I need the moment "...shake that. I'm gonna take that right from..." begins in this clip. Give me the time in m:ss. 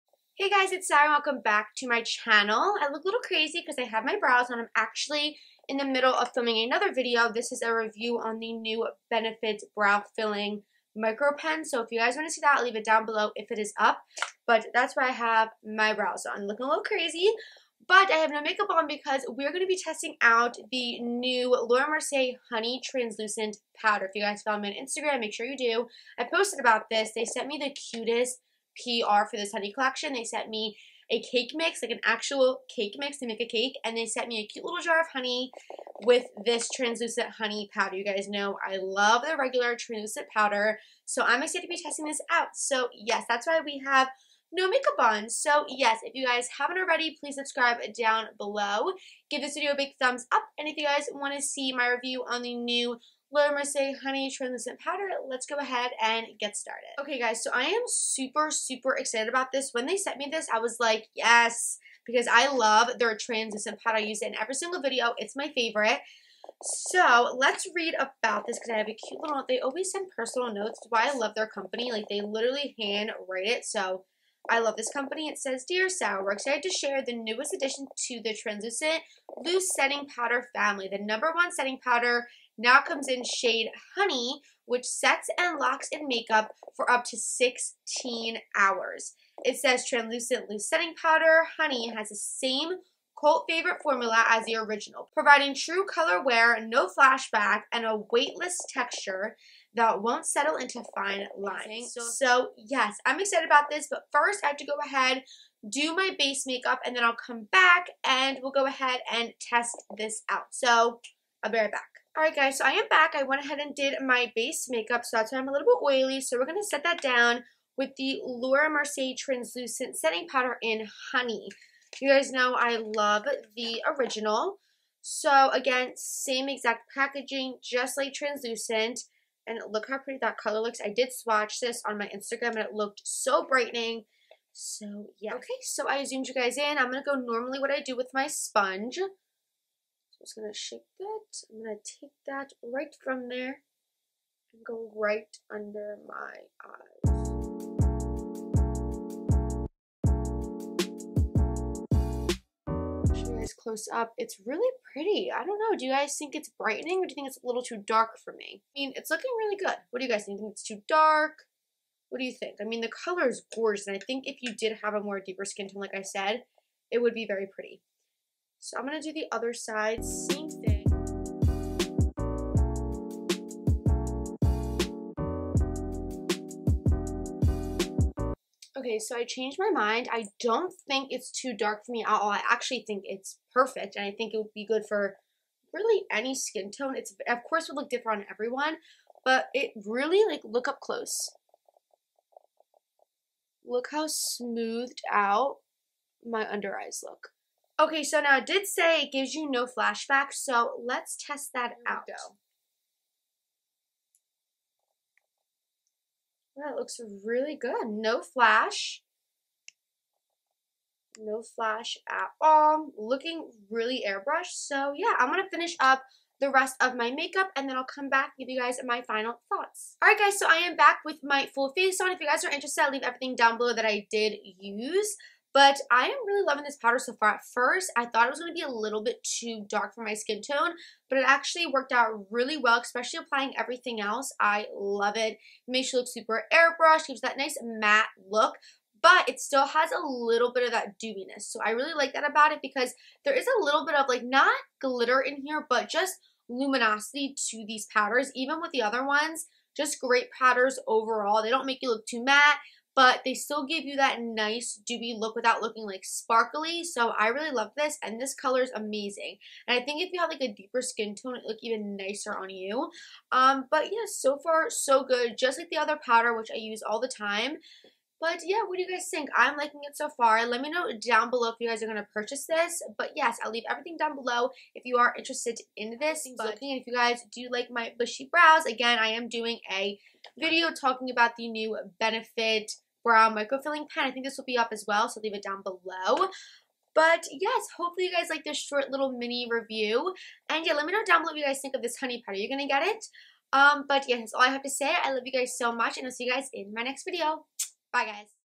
2:20.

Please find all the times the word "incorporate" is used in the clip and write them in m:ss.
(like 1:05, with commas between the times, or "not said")
not said.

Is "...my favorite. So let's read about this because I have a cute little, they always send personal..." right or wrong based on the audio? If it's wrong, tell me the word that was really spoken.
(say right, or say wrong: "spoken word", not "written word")
right.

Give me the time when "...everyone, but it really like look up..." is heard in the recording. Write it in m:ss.
3:08.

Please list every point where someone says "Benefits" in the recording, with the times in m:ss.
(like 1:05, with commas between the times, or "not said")
0:09, 4:41.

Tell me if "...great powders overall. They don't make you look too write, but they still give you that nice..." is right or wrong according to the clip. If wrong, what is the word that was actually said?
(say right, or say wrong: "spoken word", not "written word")
wrong: "matte", not "write".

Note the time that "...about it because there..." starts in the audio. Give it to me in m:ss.
4:02.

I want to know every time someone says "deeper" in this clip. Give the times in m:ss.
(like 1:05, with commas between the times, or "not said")
2:45, 4:20.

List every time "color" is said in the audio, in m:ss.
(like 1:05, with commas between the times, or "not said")
1:35, 2:10, 2:43, 4:18.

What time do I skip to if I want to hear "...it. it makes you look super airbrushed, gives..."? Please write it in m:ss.
3:55.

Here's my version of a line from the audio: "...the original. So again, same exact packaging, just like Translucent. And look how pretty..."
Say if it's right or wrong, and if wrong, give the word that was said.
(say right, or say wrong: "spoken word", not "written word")
right.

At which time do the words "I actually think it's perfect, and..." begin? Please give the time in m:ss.
3:02.